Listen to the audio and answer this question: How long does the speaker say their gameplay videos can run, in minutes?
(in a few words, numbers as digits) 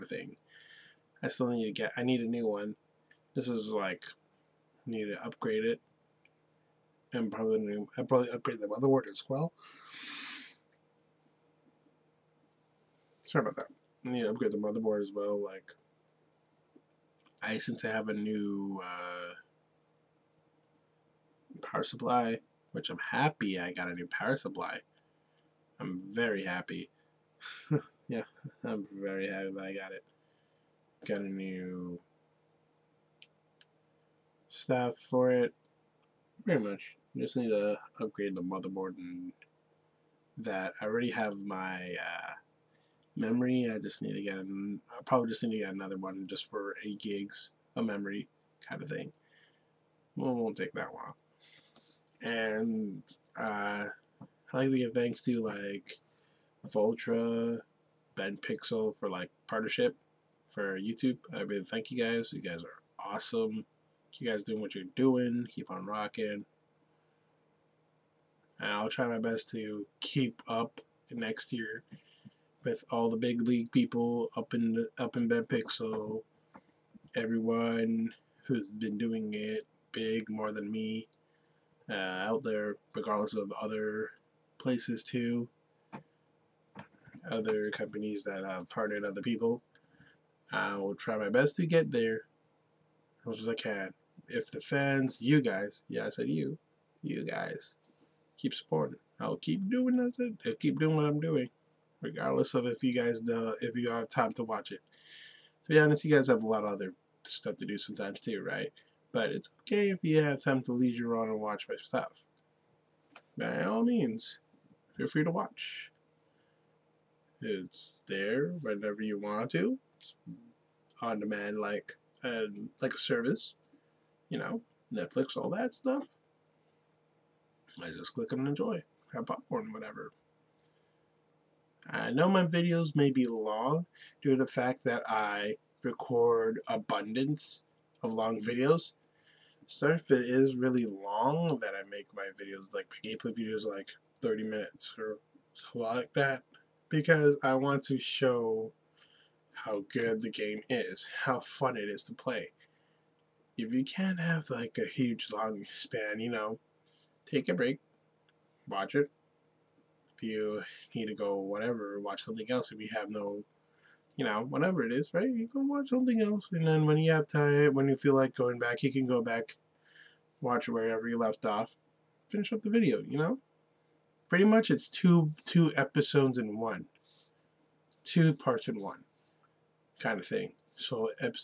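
30 minutes.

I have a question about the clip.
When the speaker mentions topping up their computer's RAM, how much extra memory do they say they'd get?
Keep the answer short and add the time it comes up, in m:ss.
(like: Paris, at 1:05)
8 gigs, at 0:46.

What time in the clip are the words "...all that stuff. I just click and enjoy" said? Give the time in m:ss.
2:05.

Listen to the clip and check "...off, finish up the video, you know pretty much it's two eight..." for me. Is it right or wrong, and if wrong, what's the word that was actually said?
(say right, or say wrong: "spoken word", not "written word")
wrong: "two", not "eight".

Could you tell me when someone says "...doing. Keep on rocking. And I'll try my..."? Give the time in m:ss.
1:04.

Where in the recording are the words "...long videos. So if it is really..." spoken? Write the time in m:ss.
2:18.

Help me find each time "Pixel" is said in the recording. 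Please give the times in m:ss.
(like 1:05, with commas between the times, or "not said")
0:58, 1:15.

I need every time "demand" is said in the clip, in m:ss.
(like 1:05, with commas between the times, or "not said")
2:01.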